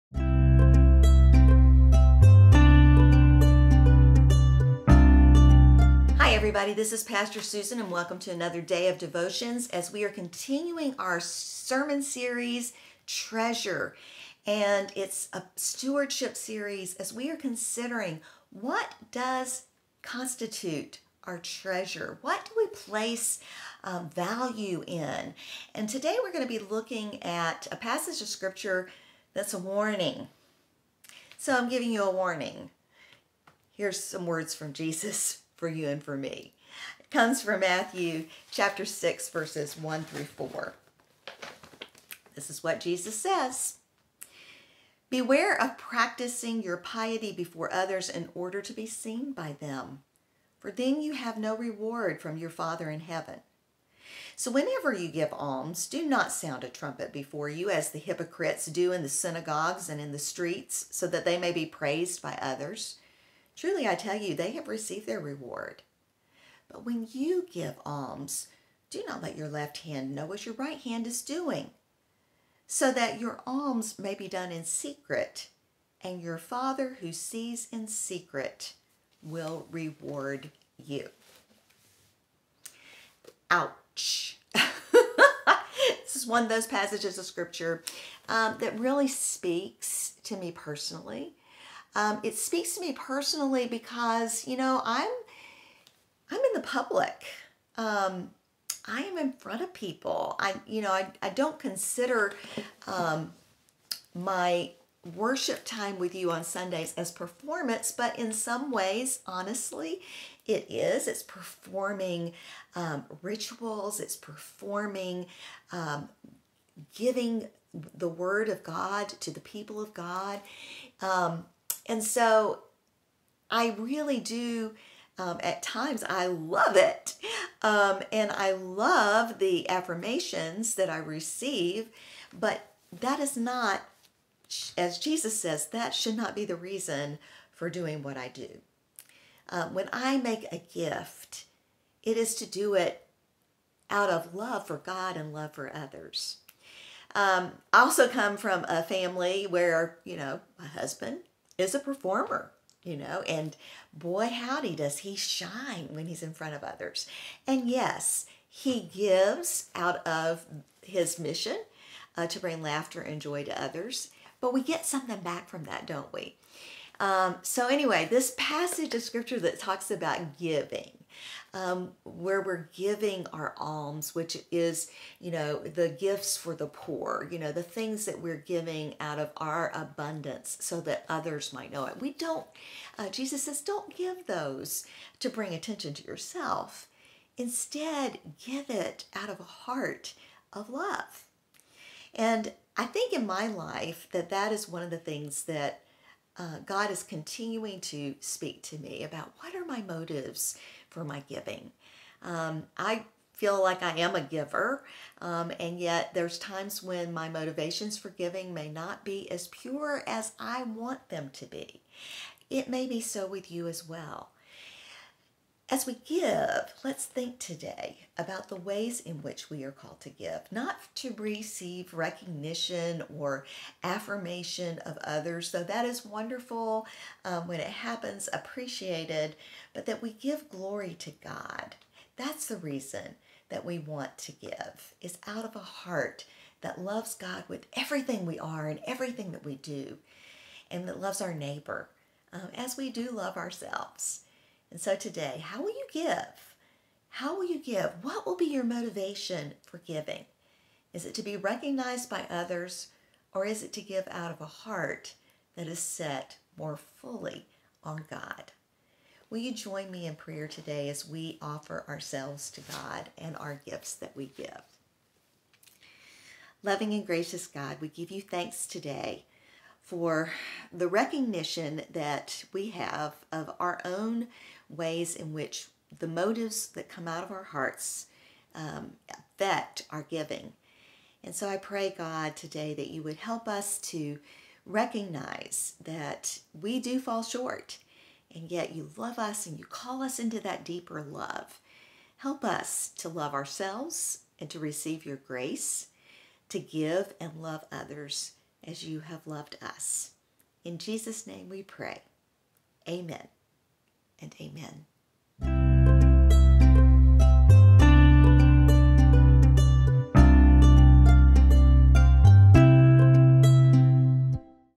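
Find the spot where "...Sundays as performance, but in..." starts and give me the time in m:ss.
1:46.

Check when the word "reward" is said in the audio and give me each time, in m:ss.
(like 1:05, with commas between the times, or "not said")
0:51, 1:05, 1:19.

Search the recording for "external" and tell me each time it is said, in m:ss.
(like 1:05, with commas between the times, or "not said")
not said.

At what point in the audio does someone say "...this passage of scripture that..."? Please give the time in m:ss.
2:48.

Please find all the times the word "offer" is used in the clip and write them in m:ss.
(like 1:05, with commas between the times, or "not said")
4:21.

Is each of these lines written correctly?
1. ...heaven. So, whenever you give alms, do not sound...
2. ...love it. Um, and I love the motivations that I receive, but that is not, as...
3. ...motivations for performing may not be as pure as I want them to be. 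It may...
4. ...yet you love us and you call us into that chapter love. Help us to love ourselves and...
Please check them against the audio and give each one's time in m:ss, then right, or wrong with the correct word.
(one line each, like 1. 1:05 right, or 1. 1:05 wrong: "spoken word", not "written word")
1. 0:53 right
2. 2:06 wrong: "affirmations", not "motivations"
3. 3:27 wrong: "giving", not "performing"
4. 4:48 wrong: "deeper", not "chapter".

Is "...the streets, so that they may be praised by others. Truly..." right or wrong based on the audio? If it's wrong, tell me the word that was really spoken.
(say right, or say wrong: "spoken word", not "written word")
right.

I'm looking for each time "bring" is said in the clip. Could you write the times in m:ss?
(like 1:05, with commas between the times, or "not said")
2:42, 3:05.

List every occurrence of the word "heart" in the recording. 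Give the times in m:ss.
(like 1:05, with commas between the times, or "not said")
3:09, 3:55, 4:14, 4:37.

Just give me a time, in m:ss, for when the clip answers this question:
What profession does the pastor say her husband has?
2:31.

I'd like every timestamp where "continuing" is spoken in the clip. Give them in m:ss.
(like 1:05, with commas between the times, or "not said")
0:10, 3:17.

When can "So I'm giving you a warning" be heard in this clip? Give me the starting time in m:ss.
0:31.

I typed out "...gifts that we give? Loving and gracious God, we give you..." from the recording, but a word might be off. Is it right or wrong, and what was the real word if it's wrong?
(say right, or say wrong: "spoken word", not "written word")
right.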